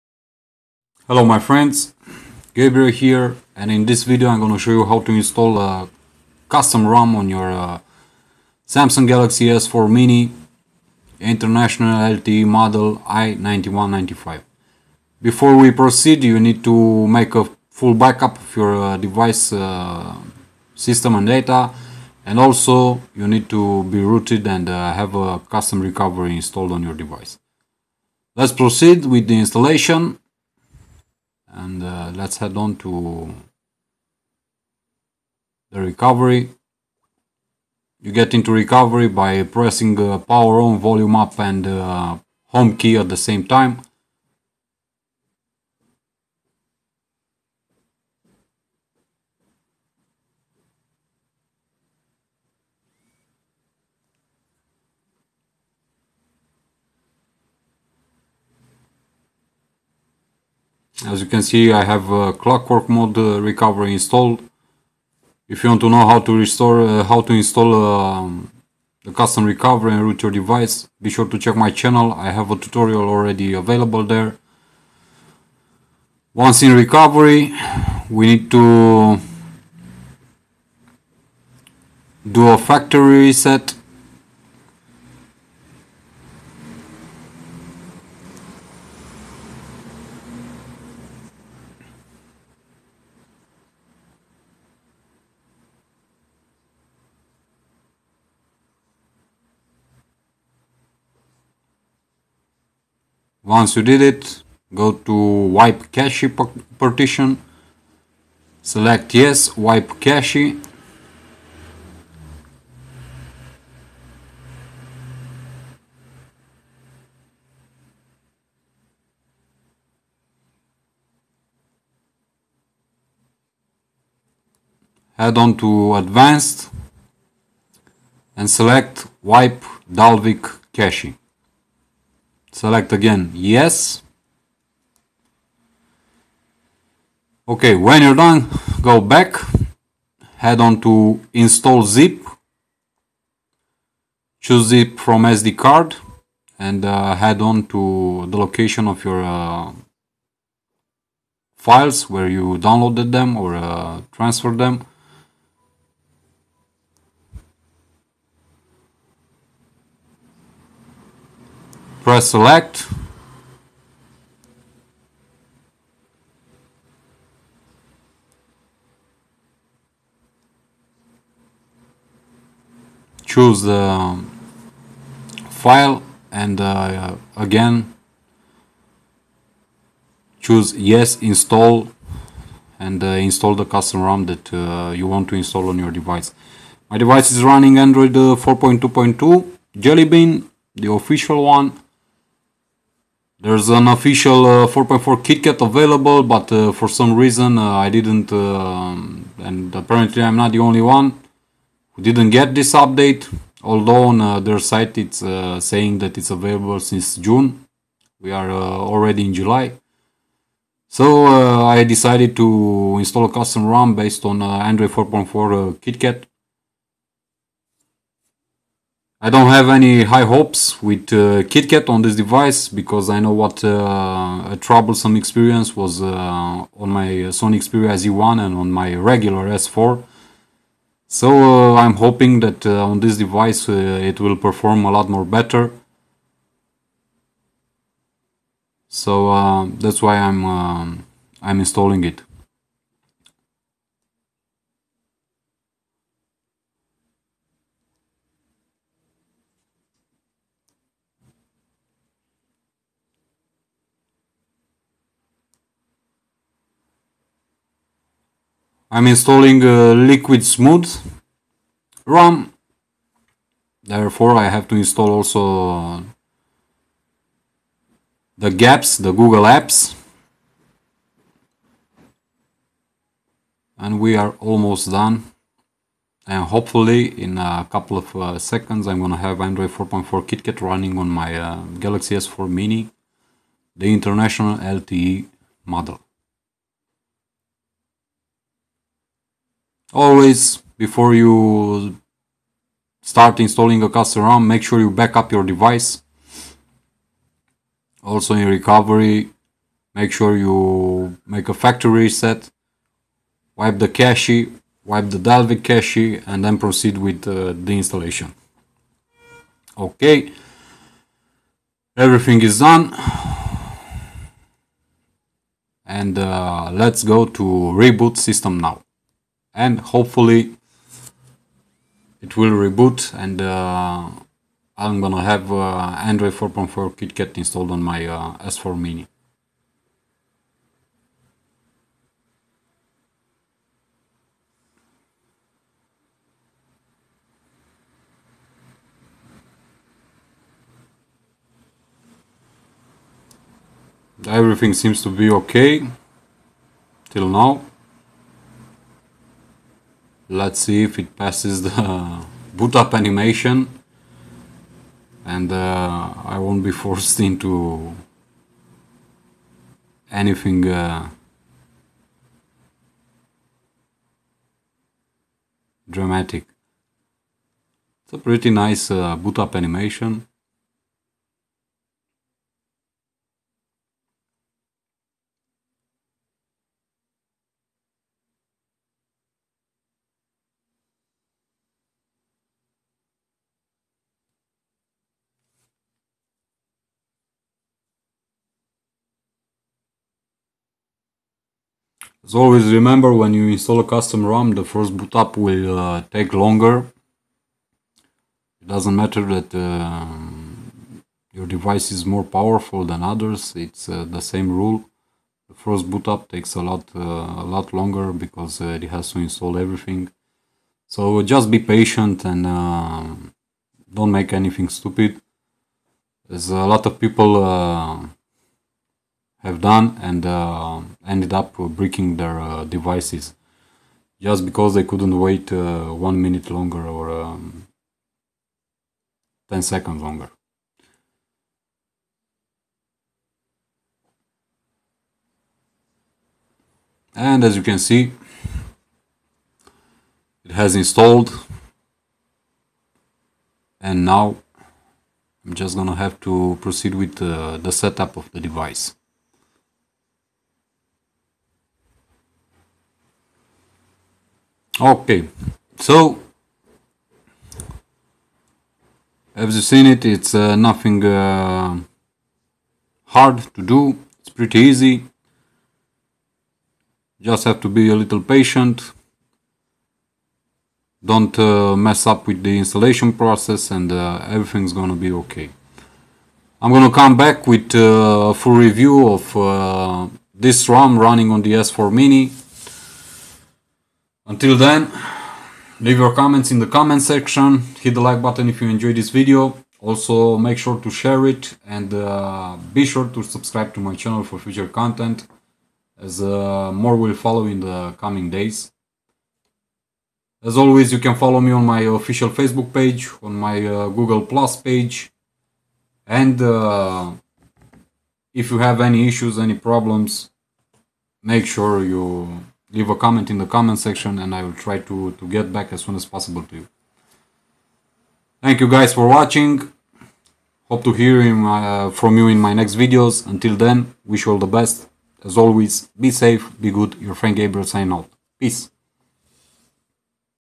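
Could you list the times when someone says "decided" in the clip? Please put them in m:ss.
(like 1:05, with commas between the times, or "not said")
3:31.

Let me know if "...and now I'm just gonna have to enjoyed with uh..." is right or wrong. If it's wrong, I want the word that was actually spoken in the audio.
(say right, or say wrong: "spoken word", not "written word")
wrong: "proceed", not "enjoyed".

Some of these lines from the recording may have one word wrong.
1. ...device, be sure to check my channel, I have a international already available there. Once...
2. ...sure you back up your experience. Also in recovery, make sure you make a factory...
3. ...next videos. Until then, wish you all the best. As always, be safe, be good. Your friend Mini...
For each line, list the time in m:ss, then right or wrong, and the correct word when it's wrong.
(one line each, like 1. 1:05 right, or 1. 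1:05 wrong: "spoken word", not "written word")
1. 1:10 wrong: "tutorial", not "international"
2. 4:54 wrong: "device", not "experience"
3. 8:42 wrong: "Gabriel", not "Mini".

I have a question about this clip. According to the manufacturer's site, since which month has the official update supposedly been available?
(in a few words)
June.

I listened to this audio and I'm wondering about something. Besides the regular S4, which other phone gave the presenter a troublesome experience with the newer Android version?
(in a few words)
Sony Xperia Z1.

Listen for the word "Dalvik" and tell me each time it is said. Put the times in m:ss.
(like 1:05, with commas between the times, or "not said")
2:09, 5:05.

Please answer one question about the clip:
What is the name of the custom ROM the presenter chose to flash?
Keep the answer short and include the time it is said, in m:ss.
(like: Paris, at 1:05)
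Liquid Smooth, at 4:19.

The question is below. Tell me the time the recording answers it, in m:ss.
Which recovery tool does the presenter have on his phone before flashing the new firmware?
1:02.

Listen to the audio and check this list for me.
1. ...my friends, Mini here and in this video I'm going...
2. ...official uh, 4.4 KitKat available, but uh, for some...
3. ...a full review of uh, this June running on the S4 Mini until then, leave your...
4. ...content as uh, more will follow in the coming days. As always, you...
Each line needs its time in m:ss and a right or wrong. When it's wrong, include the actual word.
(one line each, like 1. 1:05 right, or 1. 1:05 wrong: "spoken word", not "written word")
1. 0:01 wrong: "Gabriel", not "Mini"
2. 3:13 right
3. 7:58 wrong: "ROM", not "June"
4. 8:14 right.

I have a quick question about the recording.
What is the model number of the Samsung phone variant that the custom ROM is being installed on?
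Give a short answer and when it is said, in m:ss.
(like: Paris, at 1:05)
i9195, at 0:13.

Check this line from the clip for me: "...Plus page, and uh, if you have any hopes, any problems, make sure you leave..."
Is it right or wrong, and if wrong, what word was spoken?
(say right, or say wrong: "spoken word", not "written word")
wrong: "issues", not "hopes".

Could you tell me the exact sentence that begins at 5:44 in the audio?
Everything seems to be okay till now.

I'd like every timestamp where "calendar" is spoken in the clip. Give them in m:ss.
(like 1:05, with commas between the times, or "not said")
not said.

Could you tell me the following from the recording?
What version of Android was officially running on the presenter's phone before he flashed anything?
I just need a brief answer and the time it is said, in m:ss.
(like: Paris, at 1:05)
4.2.2 Jelly Bean, at 3:08.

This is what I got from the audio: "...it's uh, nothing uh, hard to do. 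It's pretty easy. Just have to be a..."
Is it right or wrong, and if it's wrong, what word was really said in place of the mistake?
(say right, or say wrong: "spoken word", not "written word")
right.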